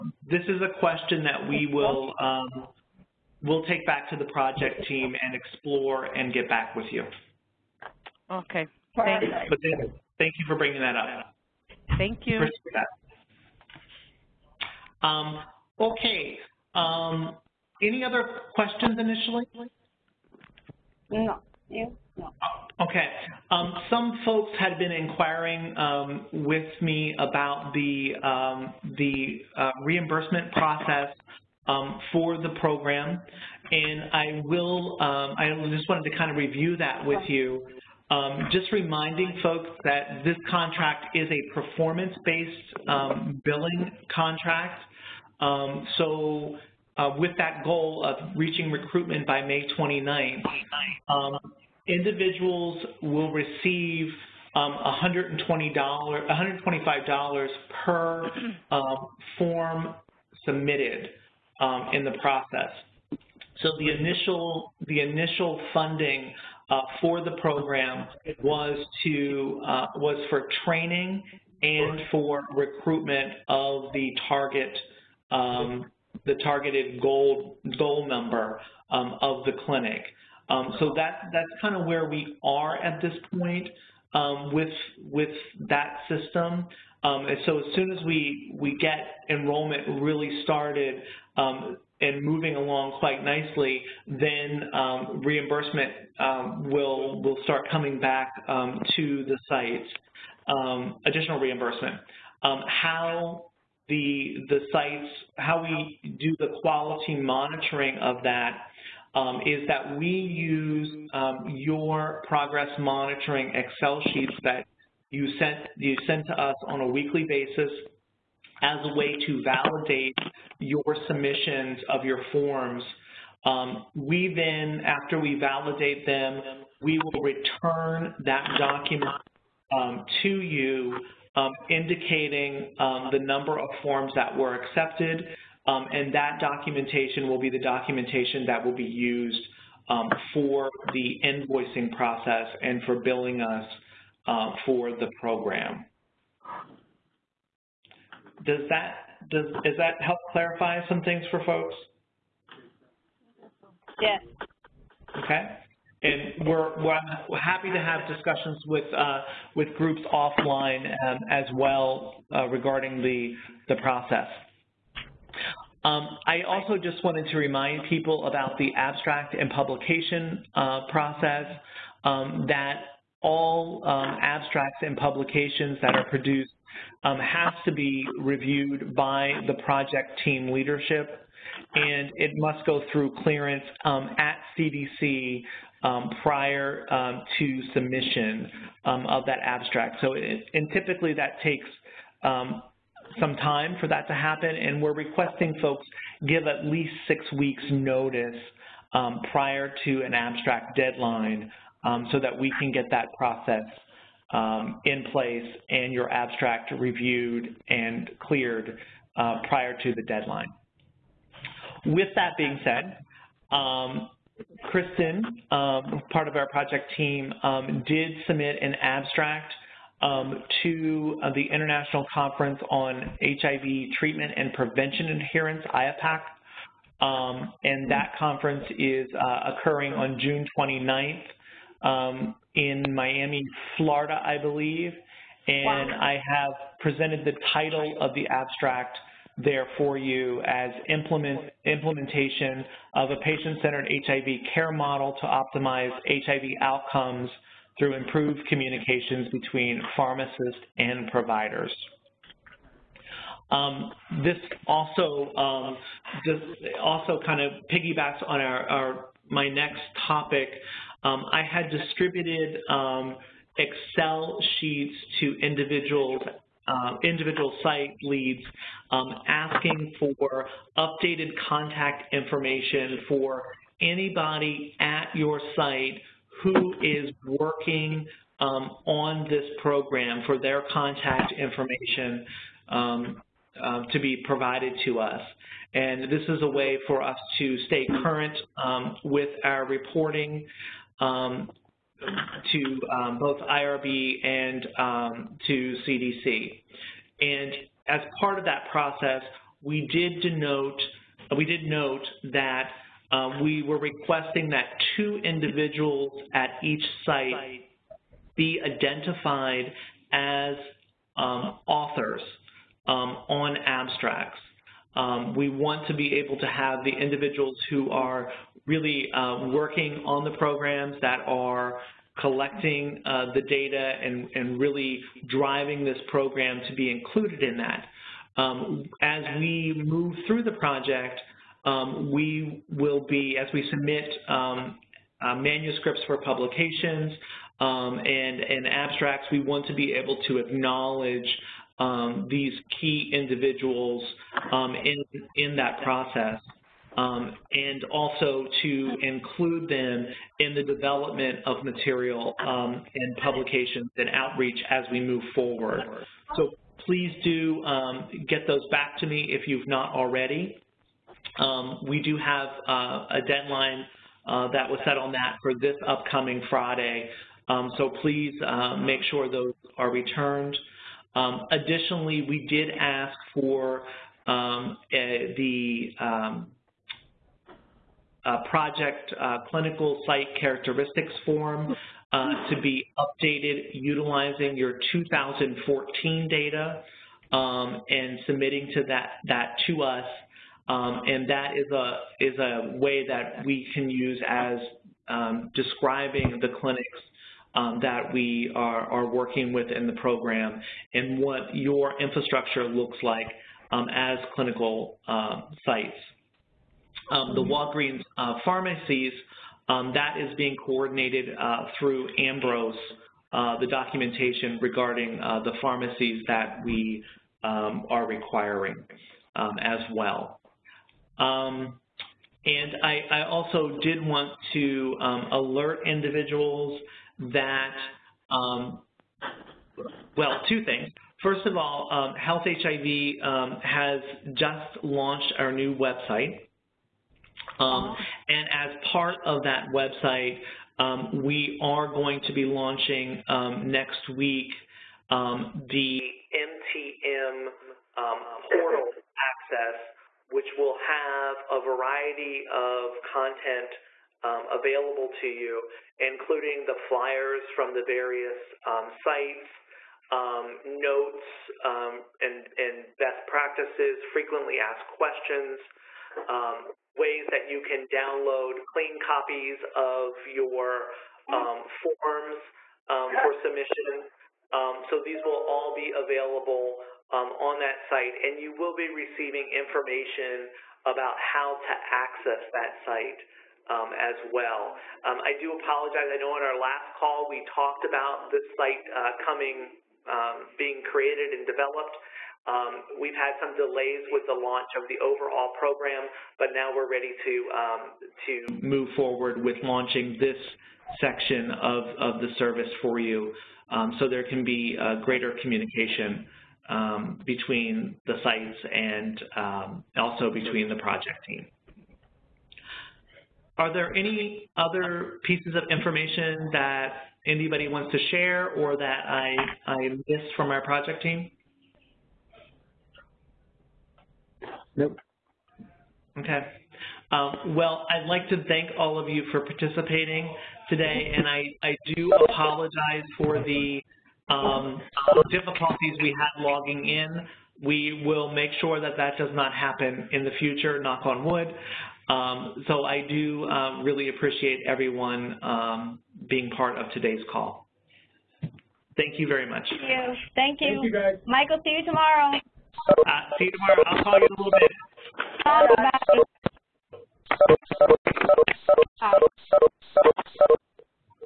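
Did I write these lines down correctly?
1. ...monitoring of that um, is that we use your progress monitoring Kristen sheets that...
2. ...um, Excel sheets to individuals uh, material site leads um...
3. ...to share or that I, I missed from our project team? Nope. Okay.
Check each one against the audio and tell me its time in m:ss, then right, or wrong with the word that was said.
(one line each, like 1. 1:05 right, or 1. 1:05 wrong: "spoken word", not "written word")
1. 1:47 wrong: "Excel", not "Kristen"
2. 4:22 wrong: "individual", not "material"
3. 8:37 right.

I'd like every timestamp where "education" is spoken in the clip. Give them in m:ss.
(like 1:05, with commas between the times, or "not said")
not said.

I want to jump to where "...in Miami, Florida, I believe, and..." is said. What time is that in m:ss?
3:52.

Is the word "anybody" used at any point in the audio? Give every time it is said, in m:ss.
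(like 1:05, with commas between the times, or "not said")
4:33, 8:37.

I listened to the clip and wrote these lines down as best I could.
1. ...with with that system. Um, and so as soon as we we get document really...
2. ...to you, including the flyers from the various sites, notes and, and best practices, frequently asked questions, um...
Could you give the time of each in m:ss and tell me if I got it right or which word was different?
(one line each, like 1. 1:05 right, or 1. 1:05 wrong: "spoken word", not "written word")
1. 1:24 wrong: "enrollment", not "document"
2. 7:35 right.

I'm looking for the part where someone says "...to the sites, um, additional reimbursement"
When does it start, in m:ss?
1:38.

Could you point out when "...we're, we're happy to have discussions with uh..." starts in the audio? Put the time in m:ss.
2:36.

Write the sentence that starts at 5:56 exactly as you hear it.
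So please do um, get those back to me if you've not already.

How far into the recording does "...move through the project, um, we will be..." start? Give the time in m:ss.
5:29.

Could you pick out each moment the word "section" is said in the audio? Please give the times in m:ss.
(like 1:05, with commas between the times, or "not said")
8:20.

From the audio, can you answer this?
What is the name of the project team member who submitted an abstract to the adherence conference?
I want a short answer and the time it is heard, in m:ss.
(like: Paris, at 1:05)
Kristen, at 3:34.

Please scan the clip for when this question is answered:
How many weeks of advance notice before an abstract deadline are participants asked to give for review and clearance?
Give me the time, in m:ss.
3:17.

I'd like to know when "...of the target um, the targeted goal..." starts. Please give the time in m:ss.
1:13.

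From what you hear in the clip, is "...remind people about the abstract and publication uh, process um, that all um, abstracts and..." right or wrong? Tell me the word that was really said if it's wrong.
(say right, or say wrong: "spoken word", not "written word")
right.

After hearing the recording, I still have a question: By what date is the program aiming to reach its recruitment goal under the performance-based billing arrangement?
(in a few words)
May 29th.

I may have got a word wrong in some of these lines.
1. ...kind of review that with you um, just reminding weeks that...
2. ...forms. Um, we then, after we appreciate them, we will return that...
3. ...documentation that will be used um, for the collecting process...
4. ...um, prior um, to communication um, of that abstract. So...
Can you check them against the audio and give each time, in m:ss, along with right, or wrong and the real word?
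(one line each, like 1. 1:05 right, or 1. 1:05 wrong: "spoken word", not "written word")
1. 0:36 wrong: "folks", not "weeks"
2. 2:02 wrong: "validate", not "appreciate"
3. 2:17 wrong: "invoicing", not "collecting"
4. 3:05 wrong: "submission", not "communication".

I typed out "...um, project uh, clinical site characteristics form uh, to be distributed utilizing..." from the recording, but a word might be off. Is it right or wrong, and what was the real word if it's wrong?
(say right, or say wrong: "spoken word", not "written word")
wrong: "updated", not "distributed".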